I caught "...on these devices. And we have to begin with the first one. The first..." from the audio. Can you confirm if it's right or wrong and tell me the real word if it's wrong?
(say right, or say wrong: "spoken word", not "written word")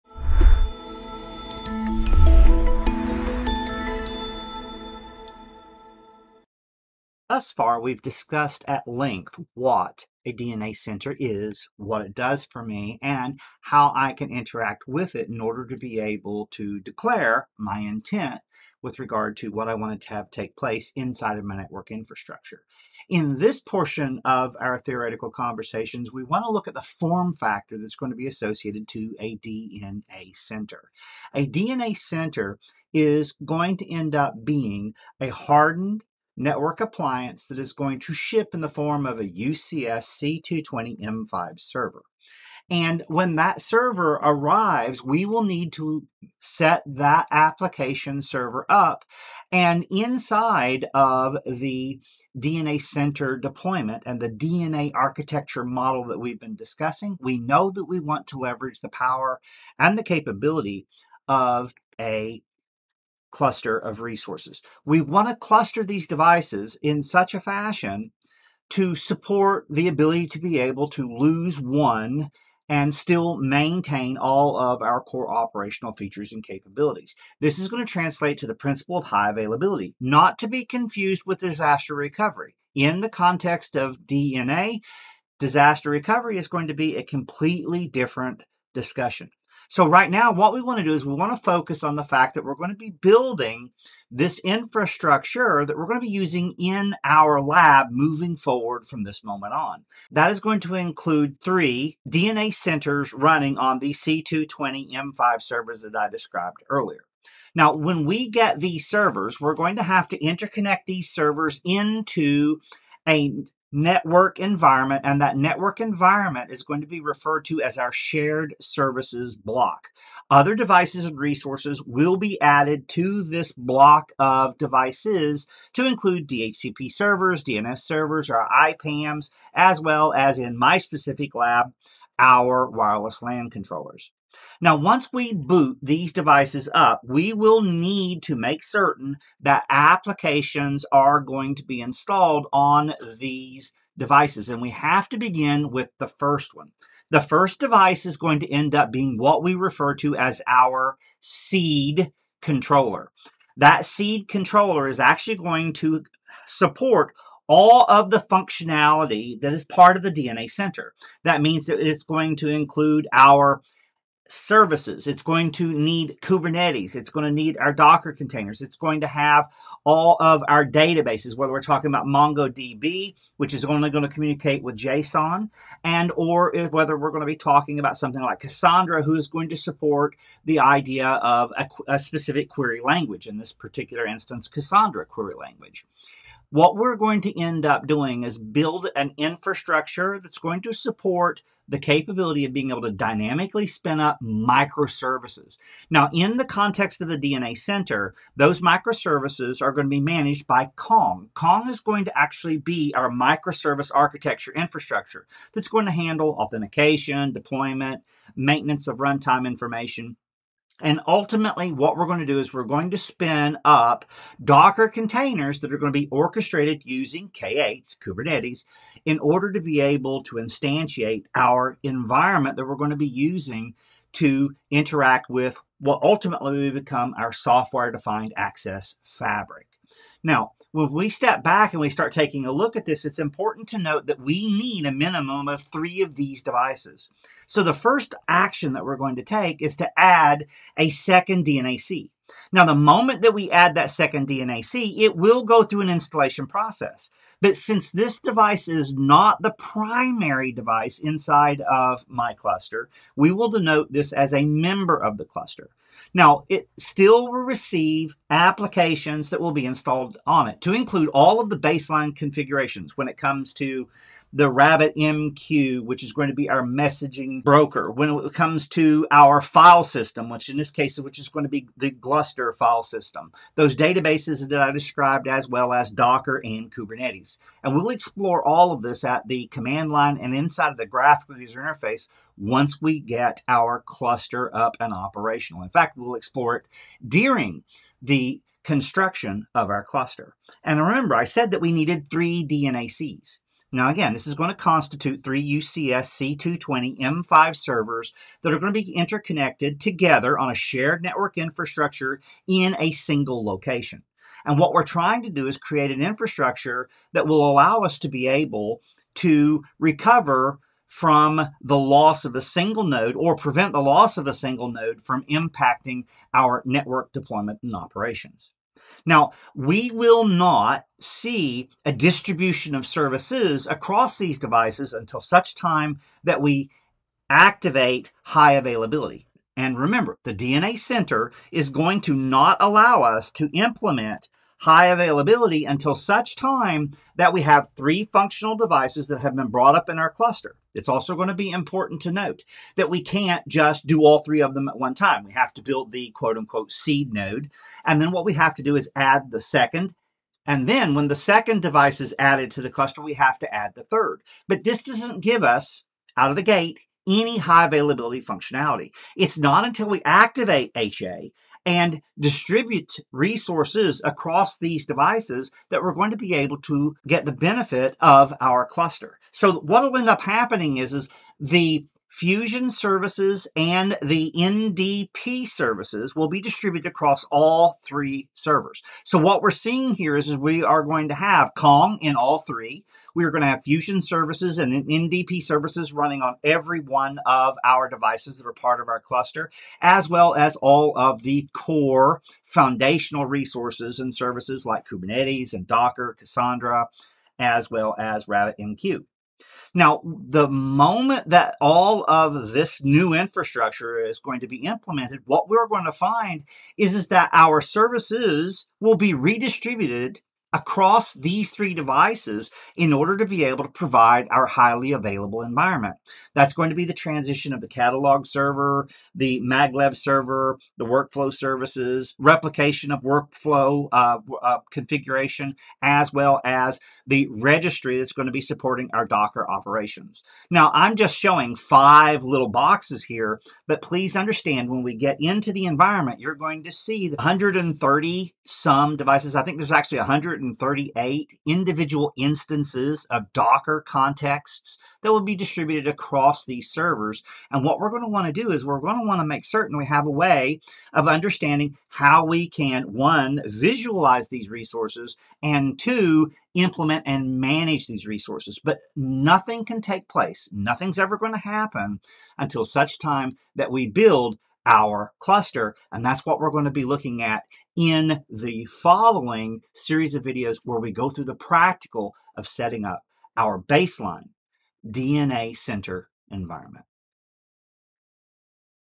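right.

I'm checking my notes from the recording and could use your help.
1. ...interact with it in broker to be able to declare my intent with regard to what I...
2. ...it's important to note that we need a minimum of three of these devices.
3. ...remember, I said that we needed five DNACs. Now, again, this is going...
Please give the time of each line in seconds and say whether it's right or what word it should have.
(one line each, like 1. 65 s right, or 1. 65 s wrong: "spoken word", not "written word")
1. 14 s wrong: "order", not "broker"
2. 233 s right
3. 290 s wrong: "three", not "five".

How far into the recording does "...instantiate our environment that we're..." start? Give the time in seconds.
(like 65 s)
220 s.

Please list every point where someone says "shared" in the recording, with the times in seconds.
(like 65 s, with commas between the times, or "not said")
117 s, 300 s.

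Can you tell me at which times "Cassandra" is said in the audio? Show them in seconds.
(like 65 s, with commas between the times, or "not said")
178 s, 184 s, 396 s.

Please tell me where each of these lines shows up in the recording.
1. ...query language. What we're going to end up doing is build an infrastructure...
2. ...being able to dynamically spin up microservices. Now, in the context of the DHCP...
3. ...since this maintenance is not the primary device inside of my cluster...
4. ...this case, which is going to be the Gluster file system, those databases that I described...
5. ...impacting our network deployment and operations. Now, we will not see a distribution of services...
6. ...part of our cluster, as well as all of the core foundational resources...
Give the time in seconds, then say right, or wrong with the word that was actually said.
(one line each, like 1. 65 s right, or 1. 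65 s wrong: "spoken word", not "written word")
1. 185 s right
2. 192 s wrong: "DNA", not "DHCP"
3. 247 s wrong: "device", not "maintenance"
4. 270 s right
5. 315 s right
6. 388 s right.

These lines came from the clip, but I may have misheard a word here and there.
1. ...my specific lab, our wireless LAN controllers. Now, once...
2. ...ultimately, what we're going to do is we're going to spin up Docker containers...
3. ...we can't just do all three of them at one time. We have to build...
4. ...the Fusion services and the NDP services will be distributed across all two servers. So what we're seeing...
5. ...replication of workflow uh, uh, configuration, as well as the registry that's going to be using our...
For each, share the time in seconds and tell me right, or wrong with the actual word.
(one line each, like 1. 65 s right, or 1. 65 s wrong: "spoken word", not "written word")
1. 130 s right
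2. 211 s right
3. 342 s right
4. 371 s wrong: "three", not "two"
5. 422 s wrong: "supporting", not "using".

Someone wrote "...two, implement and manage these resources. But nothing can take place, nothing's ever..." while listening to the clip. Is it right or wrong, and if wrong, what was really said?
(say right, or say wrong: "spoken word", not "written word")
right.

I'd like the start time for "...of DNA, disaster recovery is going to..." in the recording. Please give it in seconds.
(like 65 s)
83 s.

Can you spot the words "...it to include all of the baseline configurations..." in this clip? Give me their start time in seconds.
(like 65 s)
260 s.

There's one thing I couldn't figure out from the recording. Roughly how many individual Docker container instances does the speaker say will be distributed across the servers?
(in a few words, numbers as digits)
138.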